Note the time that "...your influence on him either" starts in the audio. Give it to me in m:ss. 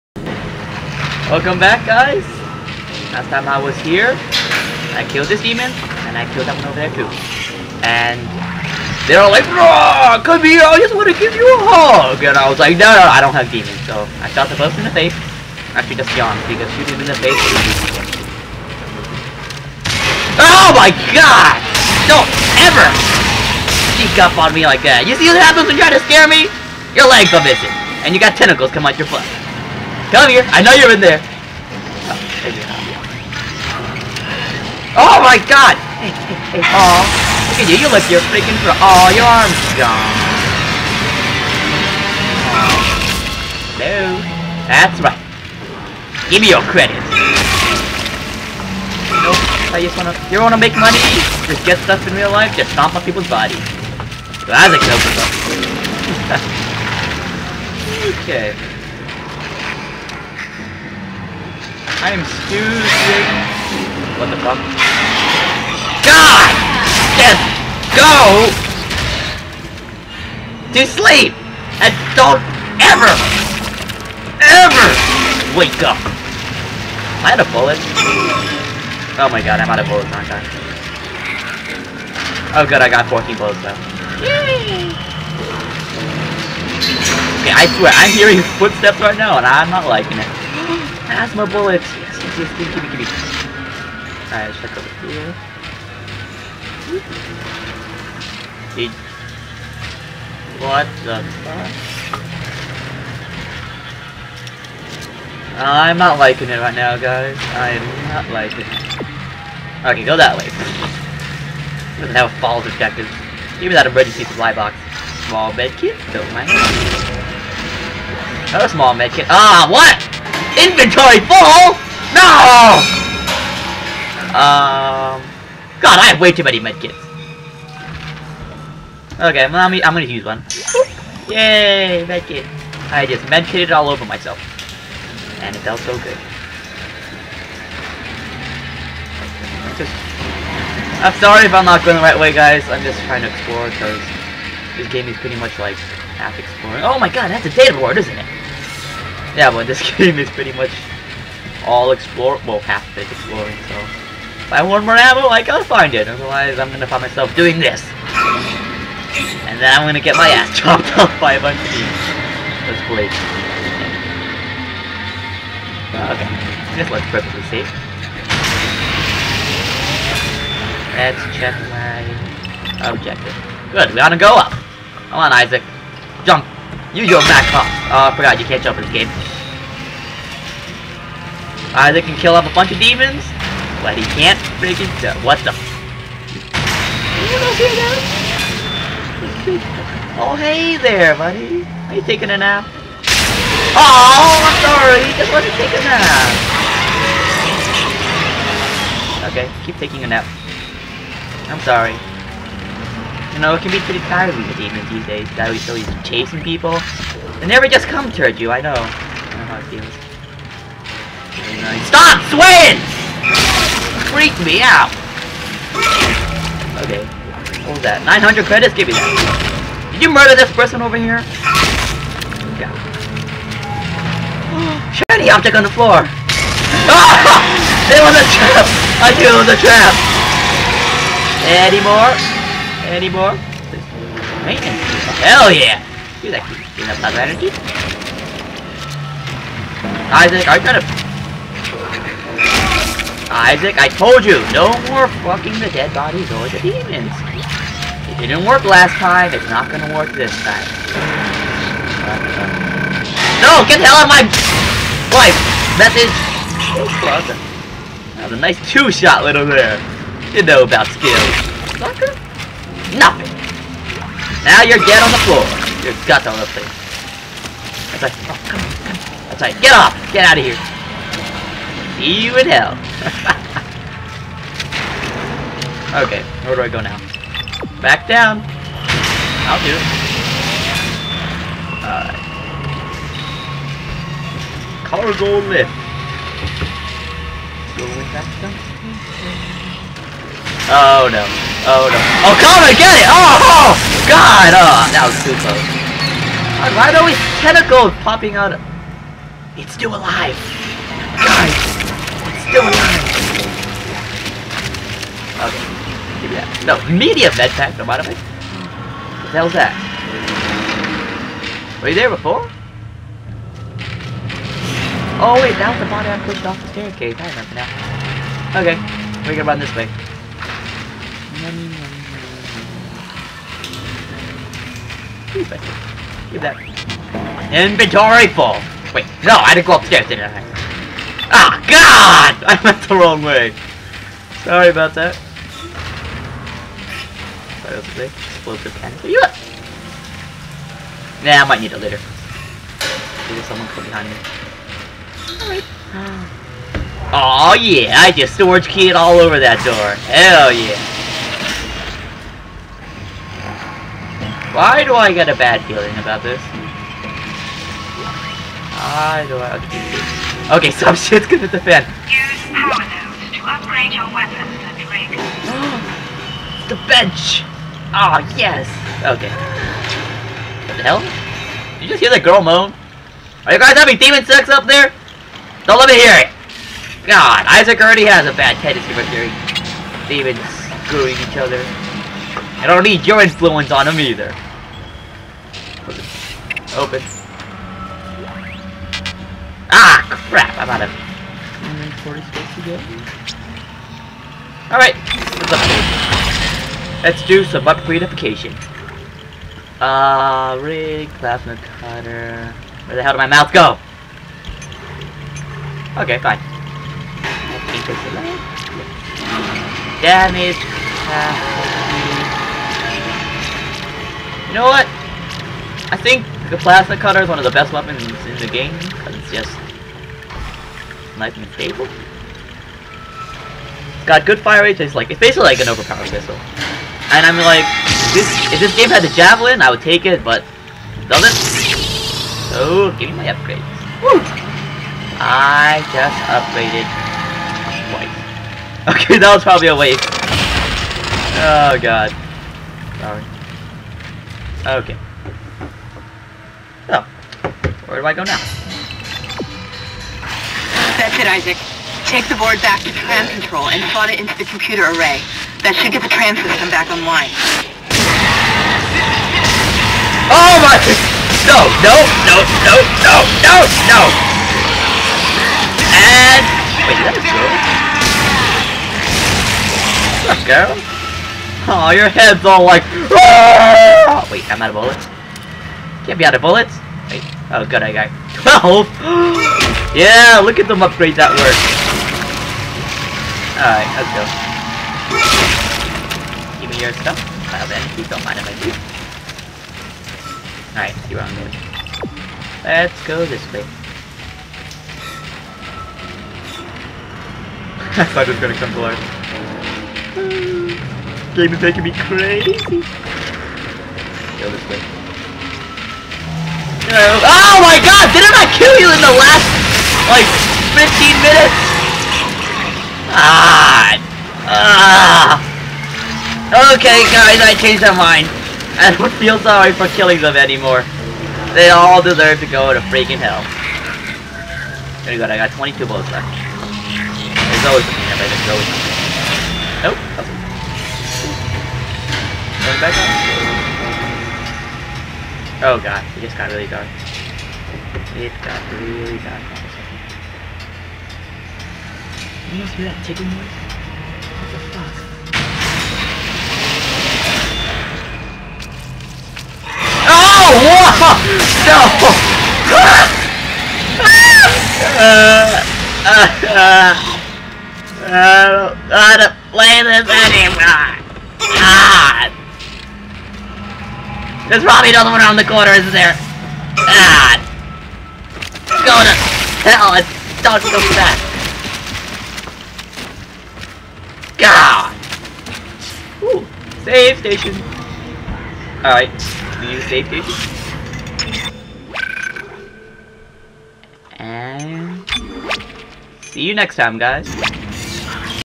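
6:23.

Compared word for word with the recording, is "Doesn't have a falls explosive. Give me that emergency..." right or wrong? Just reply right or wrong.
wrong.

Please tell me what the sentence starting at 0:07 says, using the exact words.
And they are all like, Raw, come here, I just want to give you a hug.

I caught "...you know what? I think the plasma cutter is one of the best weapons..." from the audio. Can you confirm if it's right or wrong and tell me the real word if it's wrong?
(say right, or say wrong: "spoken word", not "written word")
right.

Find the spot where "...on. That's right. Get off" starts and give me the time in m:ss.
4:28.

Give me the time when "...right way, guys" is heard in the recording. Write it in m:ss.
2:22.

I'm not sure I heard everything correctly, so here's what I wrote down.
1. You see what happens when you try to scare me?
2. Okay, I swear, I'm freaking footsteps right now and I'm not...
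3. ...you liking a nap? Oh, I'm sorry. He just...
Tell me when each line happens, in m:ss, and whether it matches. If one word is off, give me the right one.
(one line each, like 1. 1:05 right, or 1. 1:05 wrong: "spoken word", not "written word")
1. 0:25 right
2. 1:27 wrong: "hearing", not "freaking"
3. 3:11 wrong: "taking", not "liking".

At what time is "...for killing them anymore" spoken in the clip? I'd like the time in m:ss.
8:39.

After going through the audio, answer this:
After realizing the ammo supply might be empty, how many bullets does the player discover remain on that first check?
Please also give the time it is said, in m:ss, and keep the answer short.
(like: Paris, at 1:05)
14, at 1:23.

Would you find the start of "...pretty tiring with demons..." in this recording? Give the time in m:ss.
3:23.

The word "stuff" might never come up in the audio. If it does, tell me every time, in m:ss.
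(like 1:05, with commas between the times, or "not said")
0:51, 8:06.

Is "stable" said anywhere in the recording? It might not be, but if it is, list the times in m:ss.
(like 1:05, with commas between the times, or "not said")
7:01.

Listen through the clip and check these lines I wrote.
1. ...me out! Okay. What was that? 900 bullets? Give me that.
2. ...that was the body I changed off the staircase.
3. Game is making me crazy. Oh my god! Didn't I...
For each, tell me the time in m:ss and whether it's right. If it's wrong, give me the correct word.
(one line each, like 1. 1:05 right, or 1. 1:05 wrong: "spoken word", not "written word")
1. 3:34 wrong: "credits", not "bullets"
2. 5:15 wrong: "pushed", not "changed"
3. 8:21 right.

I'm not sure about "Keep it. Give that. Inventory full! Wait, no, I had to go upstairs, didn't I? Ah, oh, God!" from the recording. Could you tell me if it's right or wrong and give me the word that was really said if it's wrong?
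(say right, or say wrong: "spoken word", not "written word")
right.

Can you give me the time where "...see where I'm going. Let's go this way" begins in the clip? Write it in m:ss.
8:10.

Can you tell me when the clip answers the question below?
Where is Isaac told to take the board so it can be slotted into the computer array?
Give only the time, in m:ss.
7:32.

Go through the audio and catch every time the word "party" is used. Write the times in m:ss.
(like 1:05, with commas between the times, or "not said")
not said.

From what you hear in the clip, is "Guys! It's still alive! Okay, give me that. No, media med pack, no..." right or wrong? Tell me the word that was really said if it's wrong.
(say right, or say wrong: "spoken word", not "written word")
right.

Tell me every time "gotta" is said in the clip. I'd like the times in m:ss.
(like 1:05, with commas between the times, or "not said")
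2:35, 4:00.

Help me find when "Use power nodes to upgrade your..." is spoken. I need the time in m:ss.
6:02.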